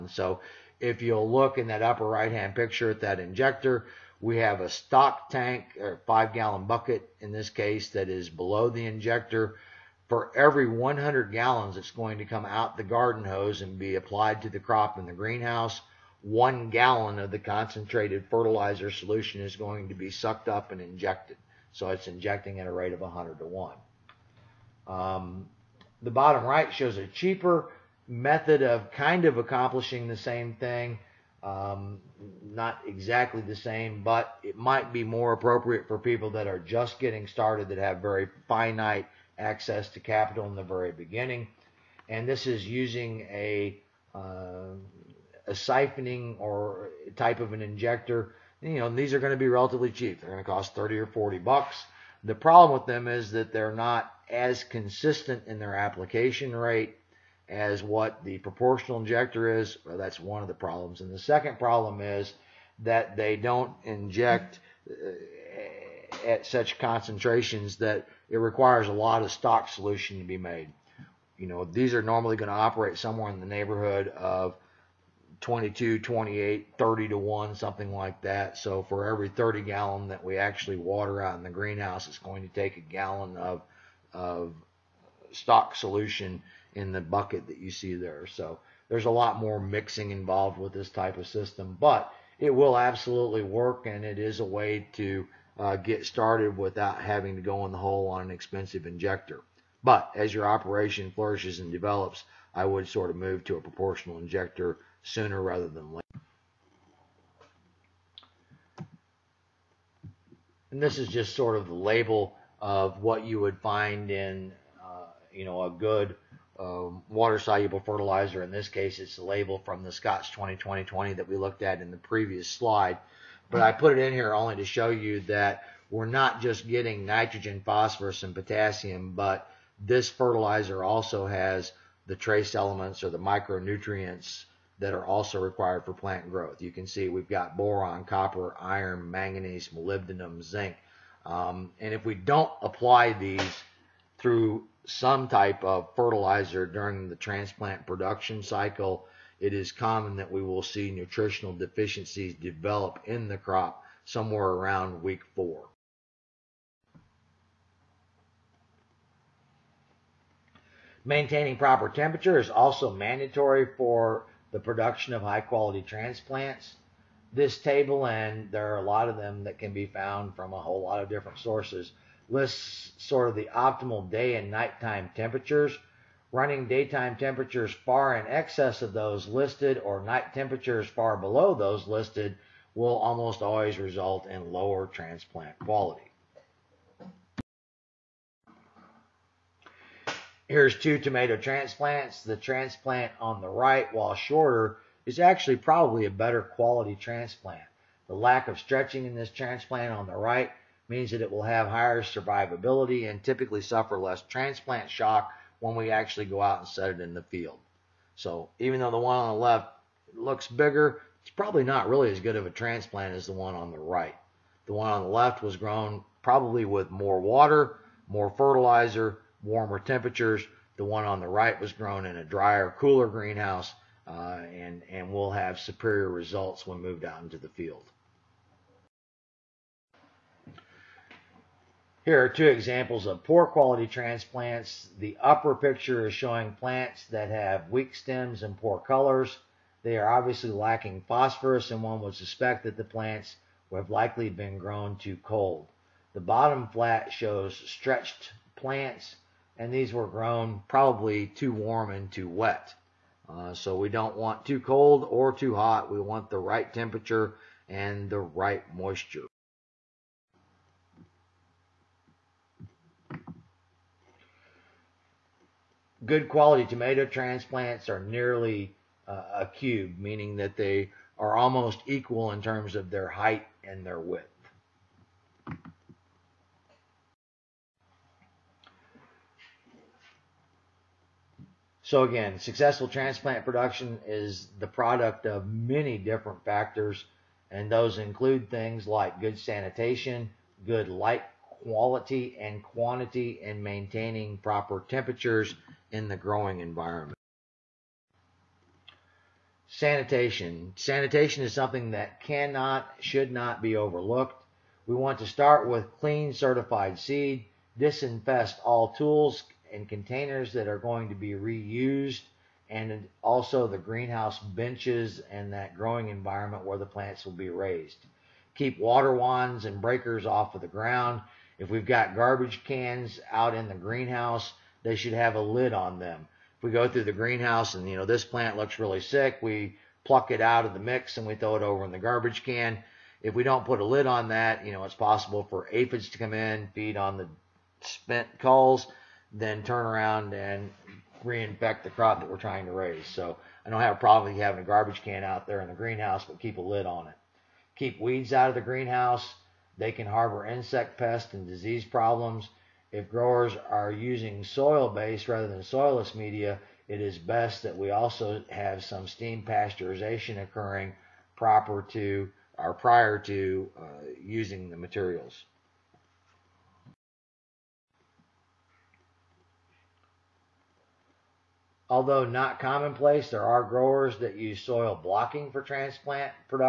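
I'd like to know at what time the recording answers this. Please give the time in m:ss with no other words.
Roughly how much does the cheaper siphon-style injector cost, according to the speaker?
0:50.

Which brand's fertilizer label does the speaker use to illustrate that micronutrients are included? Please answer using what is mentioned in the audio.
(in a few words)
Scotts.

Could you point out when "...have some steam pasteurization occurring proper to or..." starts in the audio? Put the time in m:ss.
5:58.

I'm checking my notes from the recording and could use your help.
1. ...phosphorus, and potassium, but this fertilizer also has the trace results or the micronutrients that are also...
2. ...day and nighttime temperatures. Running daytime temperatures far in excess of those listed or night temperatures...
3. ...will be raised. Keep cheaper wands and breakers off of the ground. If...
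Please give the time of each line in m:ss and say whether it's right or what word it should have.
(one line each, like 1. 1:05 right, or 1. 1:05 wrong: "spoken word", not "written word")
1. 2:07 wrong: "elements", not "results"
2. 2:54 right
3. 5:17 wrong: "water", not "cheaper".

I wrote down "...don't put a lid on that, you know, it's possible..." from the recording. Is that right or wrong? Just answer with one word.
right.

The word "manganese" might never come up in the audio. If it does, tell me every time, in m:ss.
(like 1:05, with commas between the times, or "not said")
2:19.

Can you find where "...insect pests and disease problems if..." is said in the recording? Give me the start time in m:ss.
5:50.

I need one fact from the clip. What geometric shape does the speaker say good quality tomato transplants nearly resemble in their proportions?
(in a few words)
a cube.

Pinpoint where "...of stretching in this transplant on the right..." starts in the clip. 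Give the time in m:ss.
3:18.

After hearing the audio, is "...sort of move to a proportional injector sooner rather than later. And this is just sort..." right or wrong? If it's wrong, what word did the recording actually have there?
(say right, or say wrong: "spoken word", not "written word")
right.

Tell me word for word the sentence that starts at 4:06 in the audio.
The bottom flat shows stretched plants, and these were grown probably too warm and too wet.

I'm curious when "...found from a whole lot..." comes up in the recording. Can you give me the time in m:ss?
2:49.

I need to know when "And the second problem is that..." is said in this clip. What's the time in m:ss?
1:01.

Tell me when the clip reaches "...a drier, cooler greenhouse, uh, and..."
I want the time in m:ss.
3:42.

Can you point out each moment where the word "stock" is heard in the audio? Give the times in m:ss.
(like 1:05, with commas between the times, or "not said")
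0:04, 1:09, 1:25.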